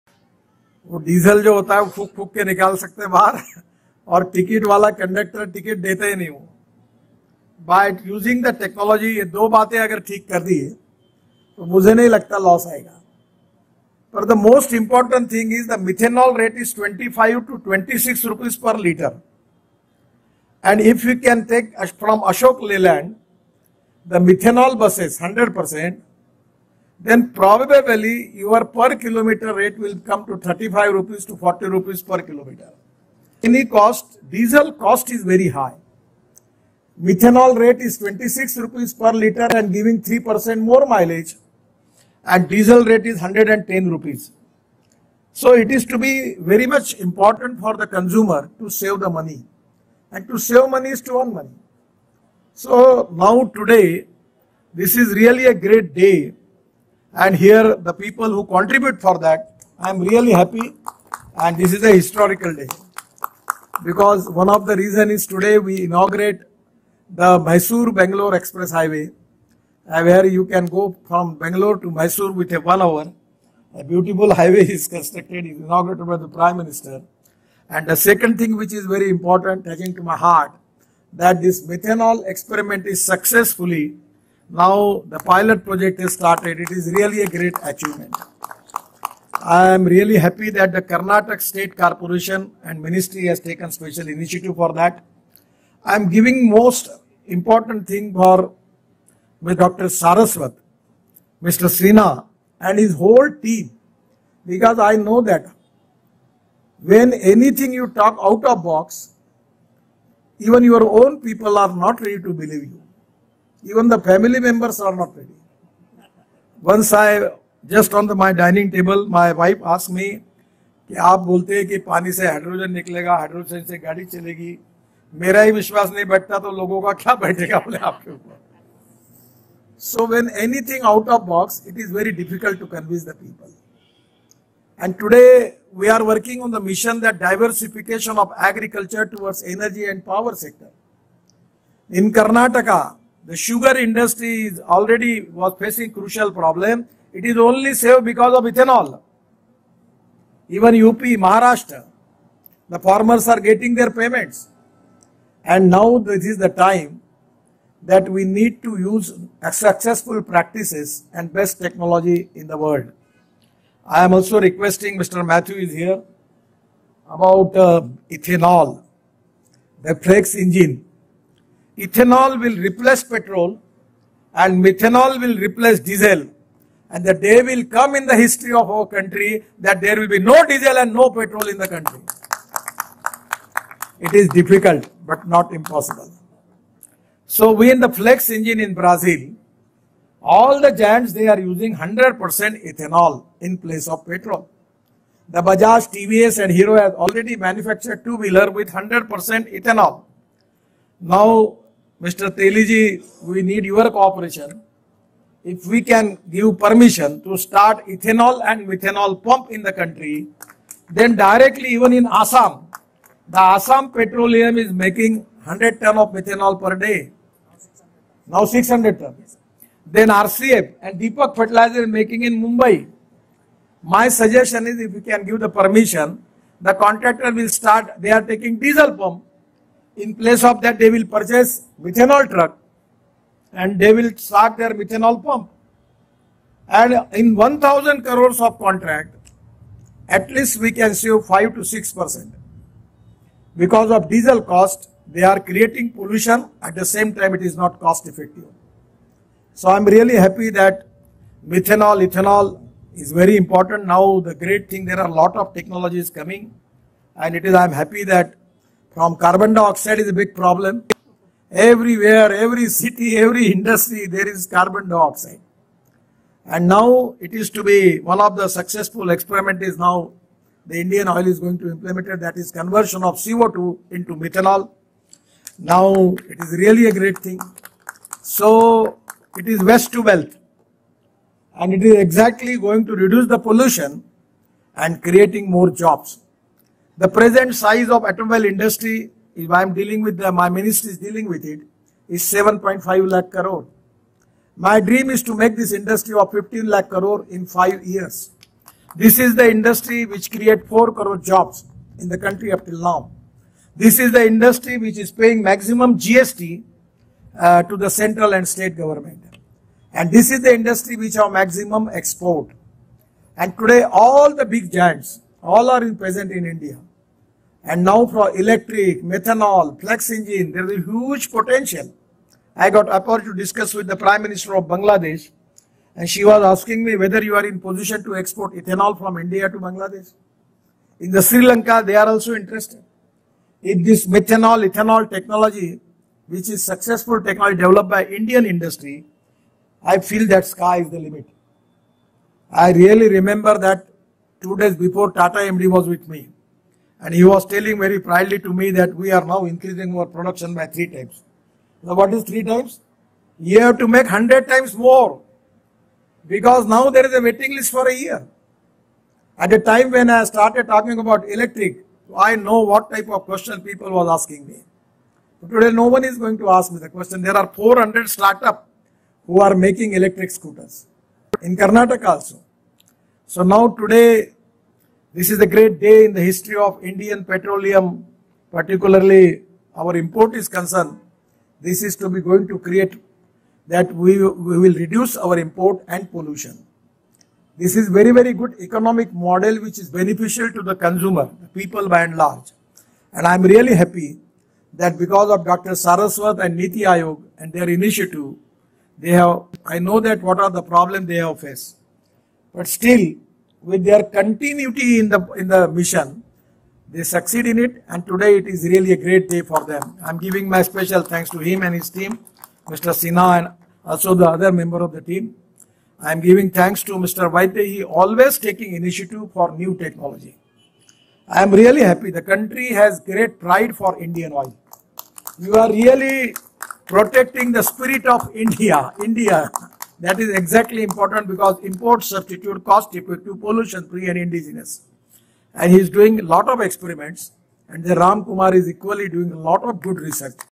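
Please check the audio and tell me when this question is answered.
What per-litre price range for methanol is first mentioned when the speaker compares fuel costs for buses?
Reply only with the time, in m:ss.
0:16.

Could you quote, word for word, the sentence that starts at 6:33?
And I'm really happy that because of Dr.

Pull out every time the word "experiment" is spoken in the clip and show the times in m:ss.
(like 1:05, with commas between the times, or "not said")
1:22, 4:29, 7:16.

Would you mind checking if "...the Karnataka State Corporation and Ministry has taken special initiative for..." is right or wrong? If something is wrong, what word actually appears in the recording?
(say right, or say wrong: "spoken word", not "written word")
right.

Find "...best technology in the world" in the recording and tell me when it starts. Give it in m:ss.
2:41.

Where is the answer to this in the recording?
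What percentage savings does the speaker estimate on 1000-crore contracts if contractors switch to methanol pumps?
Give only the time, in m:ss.
4:01.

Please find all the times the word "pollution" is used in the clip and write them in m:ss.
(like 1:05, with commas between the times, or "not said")
4:05, 4:43, 6:26, 7:13.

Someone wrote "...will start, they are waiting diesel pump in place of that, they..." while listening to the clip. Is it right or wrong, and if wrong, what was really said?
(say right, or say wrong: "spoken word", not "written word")
wrong: "taking", not "waiting".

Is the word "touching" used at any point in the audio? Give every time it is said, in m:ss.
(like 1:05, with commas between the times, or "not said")
1:19.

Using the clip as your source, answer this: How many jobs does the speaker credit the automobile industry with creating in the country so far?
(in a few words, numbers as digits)
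4 crore.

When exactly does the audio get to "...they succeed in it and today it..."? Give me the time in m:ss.
6:46.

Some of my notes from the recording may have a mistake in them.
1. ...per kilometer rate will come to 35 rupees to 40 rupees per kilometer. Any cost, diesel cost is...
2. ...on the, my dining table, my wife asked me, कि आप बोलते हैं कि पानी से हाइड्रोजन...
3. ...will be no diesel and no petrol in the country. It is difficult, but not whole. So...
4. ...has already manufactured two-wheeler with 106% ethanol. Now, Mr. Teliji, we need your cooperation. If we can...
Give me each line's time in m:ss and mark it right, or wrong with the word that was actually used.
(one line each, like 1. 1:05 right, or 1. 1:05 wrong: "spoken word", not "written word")
1. 0:28 right
2. 1:57 right
3. 2:59 wrong: "impossible", not "whole"
4. 3:16 wrong: "100", not "106".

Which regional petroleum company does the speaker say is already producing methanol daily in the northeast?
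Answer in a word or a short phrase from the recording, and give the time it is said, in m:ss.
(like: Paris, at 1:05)
Assam Petroleum, at 3:33.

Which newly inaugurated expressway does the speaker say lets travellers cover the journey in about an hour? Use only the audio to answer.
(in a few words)
Mysore-Bangalore Express Highway.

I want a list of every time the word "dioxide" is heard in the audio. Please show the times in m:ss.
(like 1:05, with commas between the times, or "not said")
4:19, 4:24.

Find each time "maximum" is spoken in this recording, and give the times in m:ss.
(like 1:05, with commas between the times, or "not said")
5:05, 5:11.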